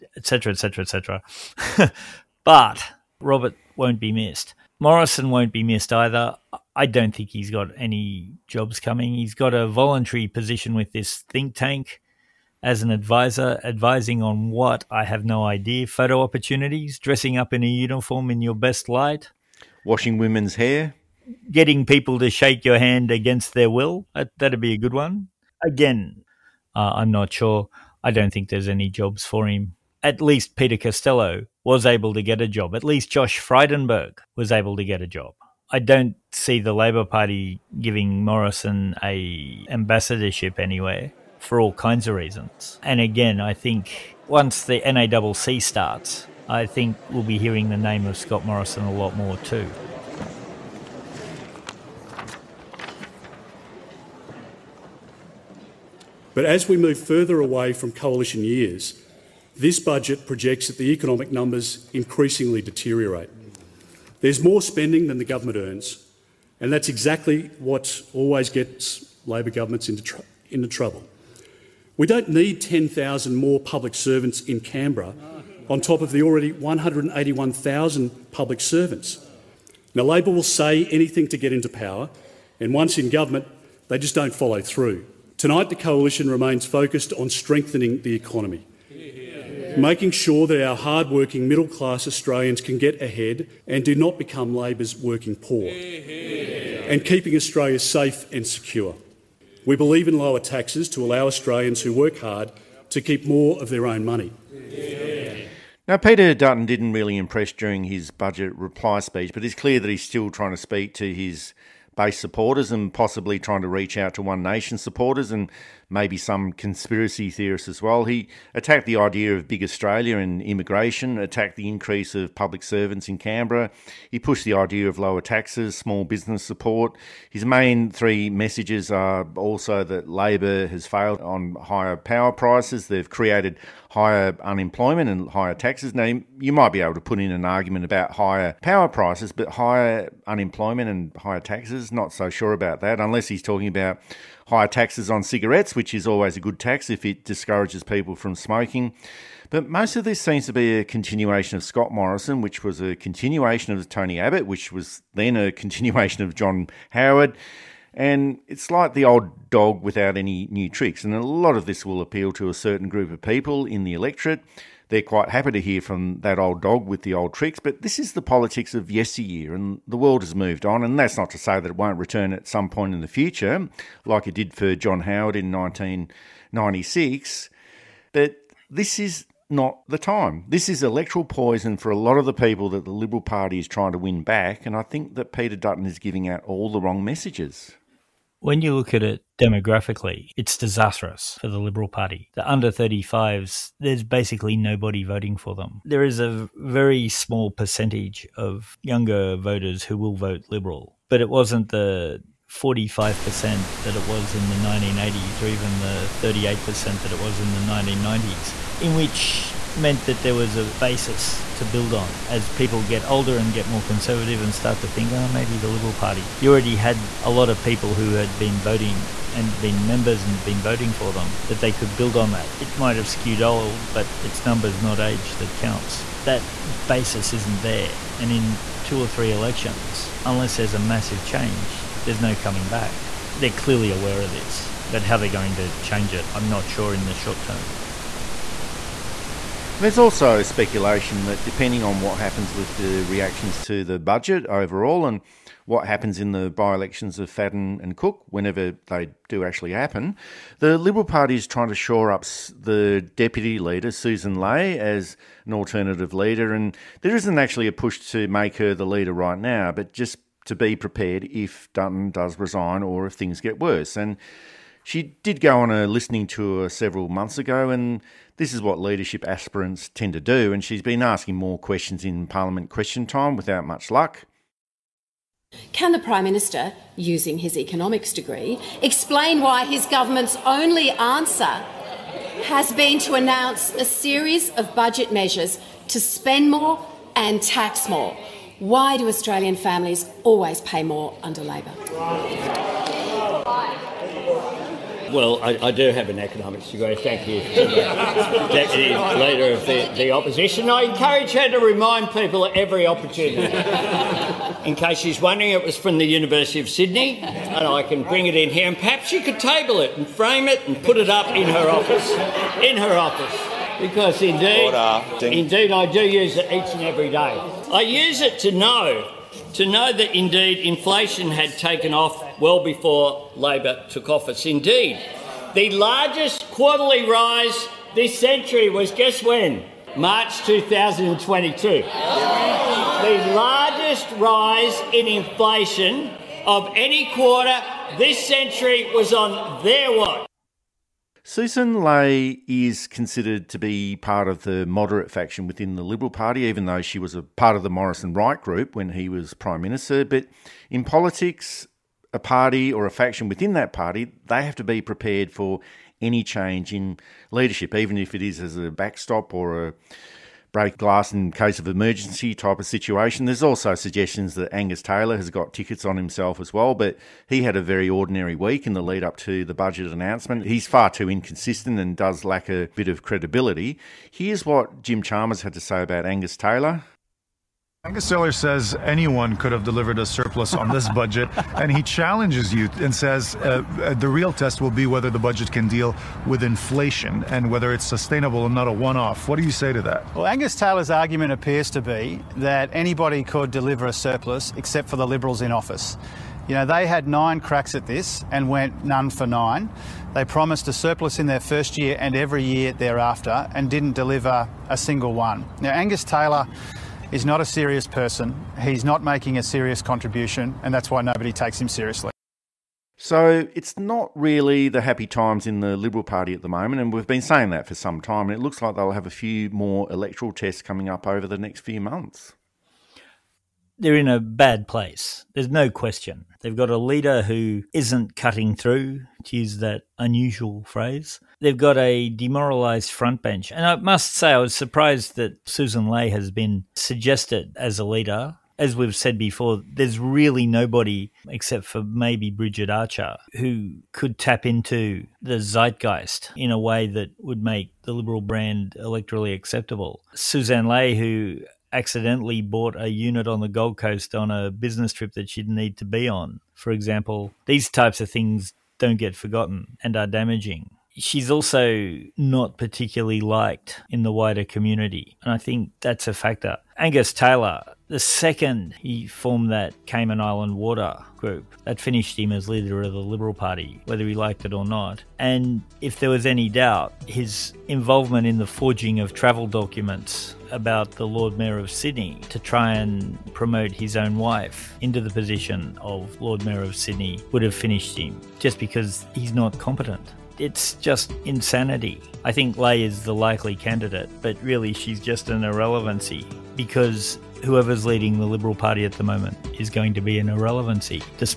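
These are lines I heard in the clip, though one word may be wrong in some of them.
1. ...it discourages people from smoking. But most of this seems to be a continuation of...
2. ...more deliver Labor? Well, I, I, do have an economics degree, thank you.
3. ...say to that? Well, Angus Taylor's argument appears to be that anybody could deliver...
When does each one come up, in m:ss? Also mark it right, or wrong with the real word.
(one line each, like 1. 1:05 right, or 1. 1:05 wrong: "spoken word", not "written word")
1. 2:27 right
2. 4:50 wrong: "under", not "deliver"
3. 6:29 right.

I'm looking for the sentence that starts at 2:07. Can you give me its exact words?
His main three messages are also that Labor has failed on higher power prices.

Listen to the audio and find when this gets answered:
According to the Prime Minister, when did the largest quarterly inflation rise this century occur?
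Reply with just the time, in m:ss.
5:29.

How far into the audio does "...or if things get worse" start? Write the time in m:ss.
4:22.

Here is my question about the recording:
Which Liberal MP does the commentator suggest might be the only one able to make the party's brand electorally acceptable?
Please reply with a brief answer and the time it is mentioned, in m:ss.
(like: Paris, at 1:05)
Bridget Archer, at 7:22.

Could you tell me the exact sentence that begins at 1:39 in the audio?
We believe in lower taxes to allow Australians who work hard to keep more of their own money.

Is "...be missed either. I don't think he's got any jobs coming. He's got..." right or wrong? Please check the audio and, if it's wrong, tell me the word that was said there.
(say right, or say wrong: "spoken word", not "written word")
right.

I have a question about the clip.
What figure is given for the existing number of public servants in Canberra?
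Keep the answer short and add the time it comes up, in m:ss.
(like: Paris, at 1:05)
181,000, at 1:16.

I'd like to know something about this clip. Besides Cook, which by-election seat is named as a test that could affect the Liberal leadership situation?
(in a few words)
Fadden.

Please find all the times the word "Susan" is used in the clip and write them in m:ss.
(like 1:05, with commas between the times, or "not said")
4:13, 5:41, 7:15.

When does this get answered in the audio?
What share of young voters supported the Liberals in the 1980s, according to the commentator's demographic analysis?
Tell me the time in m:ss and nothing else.
3:22.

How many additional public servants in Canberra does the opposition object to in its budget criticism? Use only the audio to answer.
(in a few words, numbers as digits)
10,000.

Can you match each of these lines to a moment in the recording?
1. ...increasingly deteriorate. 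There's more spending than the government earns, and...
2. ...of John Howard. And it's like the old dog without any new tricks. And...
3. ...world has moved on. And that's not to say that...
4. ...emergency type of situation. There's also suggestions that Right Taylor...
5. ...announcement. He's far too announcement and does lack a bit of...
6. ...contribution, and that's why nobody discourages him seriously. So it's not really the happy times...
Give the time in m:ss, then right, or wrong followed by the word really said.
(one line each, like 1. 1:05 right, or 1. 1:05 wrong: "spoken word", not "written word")
1. 1:01 right
2. 2:36 right
3. 2:49 right
4. 6:01 wrong: "Angus", not "Right"
5. 6:09 wrong: "inconsistent", not "announcement"
6. 6:49 wrong: "takes", not "discourages".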